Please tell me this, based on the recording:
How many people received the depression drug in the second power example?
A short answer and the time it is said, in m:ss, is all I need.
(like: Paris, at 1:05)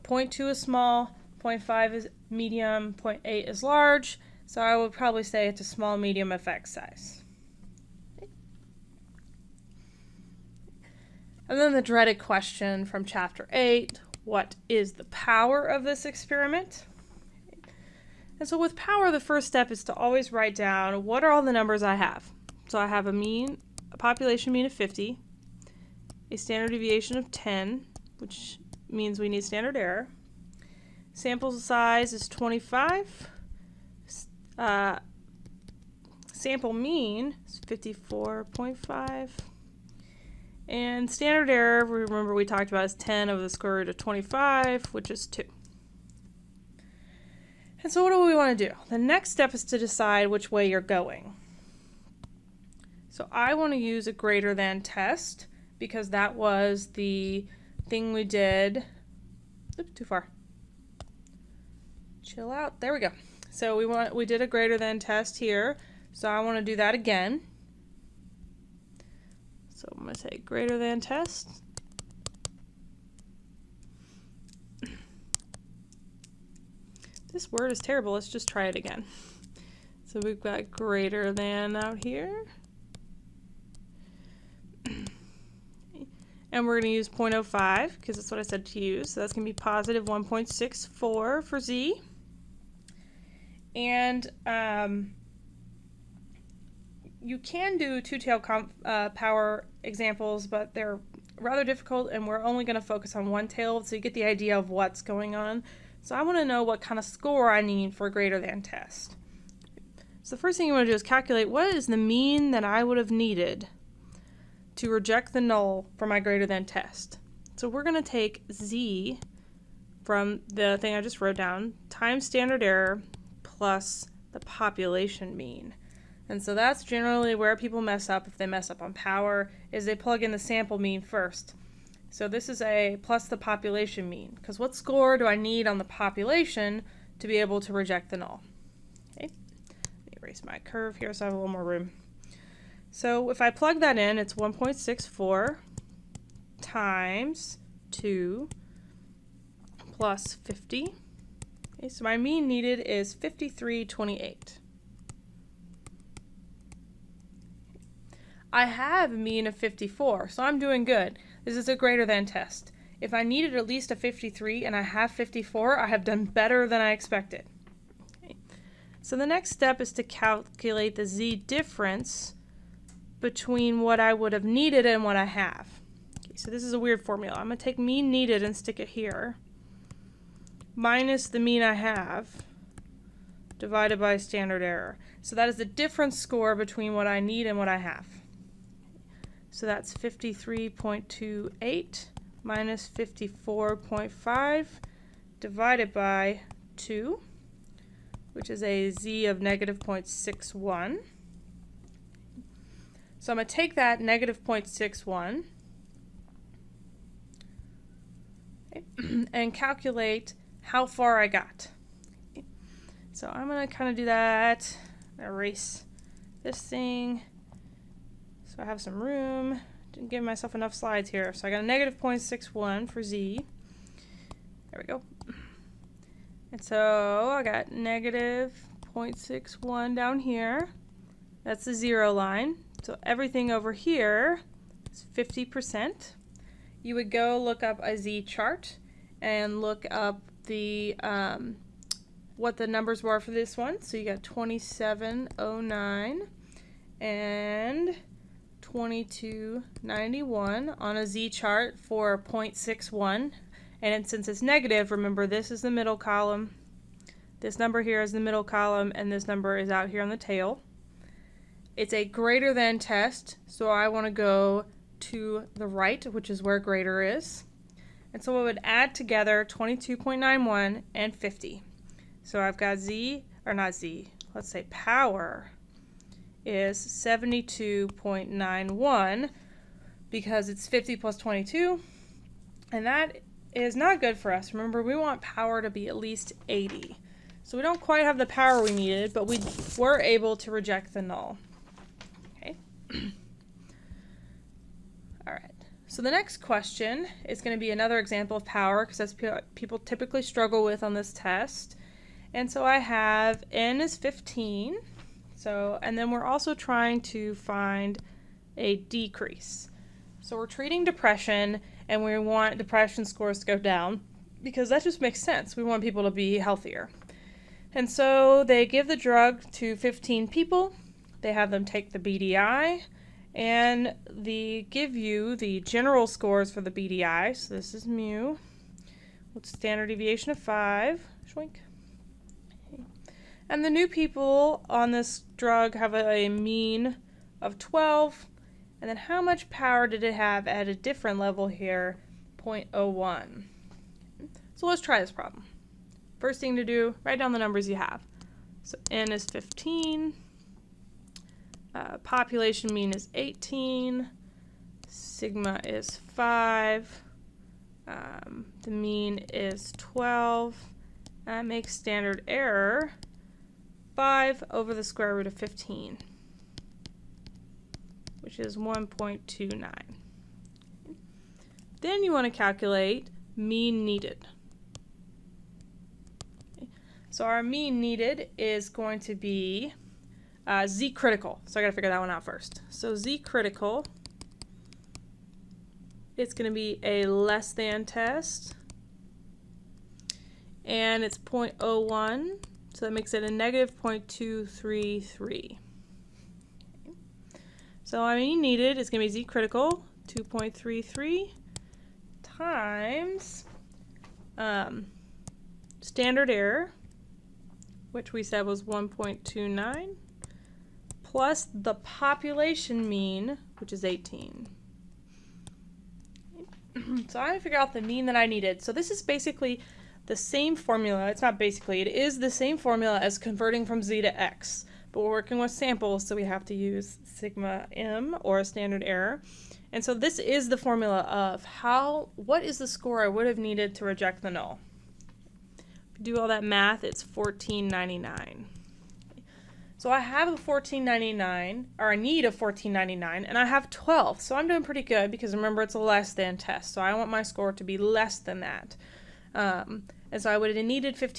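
15, at 5:19.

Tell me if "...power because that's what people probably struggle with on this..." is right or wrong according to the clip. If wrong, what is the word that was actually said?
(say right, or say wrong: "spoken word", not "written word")
wrong: "typically", not "probably".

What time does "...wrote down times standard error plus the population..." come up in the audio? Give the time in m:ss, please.
2:01.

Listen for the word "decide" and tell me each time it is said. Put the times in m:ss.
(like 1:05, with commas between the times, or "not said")
0:49.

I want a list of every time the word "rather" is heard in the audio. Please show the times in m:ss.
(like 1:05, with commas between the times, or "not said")
1:41.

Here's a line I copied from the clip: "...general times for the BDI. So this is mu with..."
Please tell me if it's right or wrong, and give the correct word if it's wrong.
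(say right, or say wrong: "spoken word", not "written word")
wrong: "scores", not "times".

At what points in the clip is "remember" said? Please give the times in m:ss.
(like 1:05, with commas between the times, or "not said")
0:41, 4:14, 4:44, 7:25.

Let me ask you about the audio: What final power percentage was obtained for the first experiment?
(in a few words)
72.91.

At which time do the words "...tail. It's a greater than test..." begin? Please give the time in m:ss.
4:20.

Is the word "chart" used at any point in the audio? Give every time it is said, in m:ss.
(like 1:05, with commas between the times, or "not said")
3:58, 4:11.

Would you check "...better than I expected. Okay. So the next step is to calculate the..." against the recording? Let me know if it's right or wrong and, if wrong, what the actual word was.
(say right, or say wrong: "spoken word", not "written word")
right.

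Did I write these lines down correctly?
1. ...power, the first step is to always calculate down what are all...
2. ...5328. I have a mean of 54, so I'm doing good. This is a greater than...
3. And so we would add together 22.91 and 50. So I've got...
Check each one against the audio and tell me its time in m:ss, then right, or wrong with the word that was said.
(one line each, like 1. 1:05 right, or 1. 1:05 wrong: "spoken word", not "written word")
1. 0:18 wrong: "write", not "calculate"
2. 2:33 right
3. 4:28 right.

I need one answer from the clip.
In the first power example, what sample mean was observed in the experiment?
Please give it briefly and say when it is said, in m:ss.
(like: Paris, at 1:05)
54.5, at 0:36.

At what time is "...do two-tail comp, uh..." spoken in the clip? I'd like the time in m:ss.
1:37.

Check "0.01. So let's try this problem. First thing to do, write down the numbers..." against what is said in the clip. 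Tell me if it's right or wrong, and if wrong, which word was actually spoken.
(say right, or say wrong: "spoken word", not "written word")
right.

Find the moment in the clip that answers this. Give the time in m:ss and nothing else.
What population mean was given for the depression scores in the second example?
5:51.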